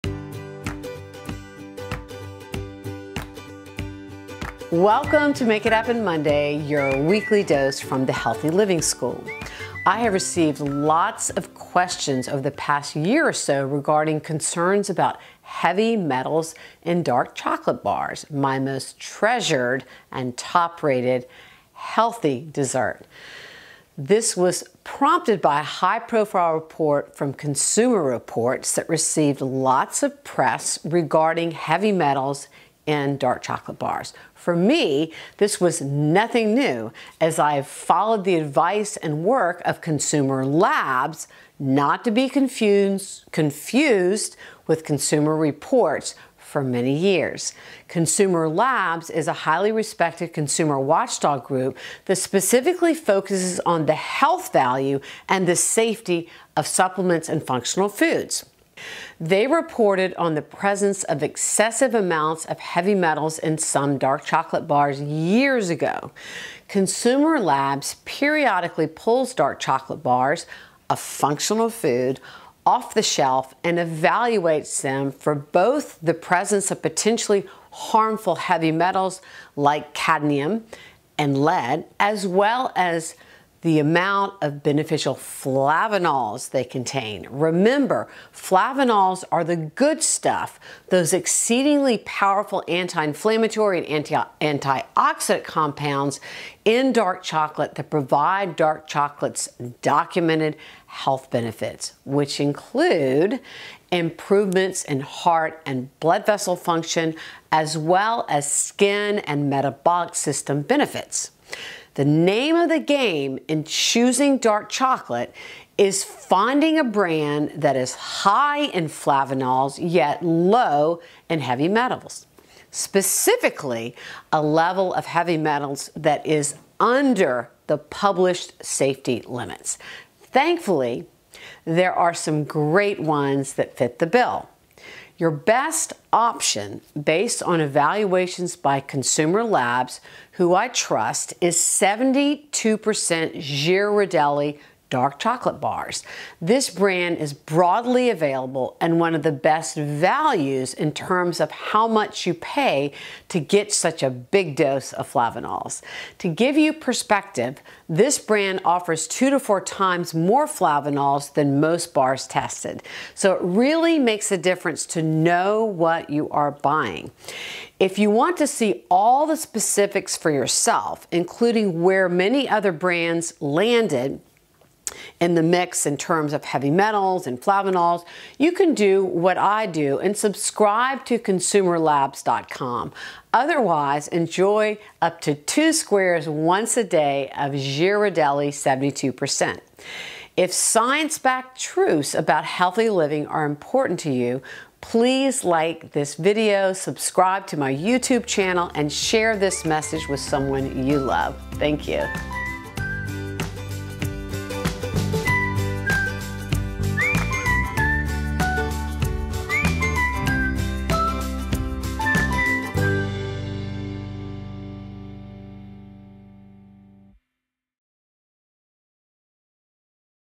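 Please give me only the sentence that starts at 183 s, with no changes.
Otherwise, enjoy up to two squares once a day of Ghirardelli 72%.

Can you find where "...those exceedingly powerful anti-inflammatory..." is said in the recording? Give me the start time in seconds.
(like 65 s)
90 s.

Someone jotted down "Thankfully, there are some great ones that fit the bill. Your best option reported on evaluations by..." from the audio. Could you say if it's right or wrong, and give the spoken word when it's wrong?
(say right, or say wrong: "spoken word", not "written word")
wrong: "based", not "reported".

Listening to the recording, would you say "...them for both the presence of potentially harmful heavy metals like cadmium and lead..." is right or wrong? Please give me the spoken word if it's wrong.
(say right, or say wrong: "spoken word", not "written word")
right.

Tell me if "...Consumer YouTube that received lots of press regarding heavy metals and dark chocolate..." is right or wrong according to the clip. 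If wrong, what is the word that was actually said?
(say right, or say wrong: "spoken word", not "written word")
wrong: "Reports", not "YouTube".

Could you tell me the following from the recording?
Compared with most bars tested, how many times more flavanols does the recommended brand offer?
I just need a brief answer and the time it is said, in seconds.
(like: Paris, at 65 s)
2 to 4 times, at 159 s.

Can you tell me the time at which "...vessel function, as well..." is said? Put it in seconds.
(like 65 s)
106 s.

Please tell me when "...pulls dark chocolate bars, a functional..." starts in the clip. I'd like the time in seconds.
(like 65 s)
68 s.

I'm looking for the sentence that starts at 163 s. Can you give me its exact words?
So it really makes a difference to know what you are buying.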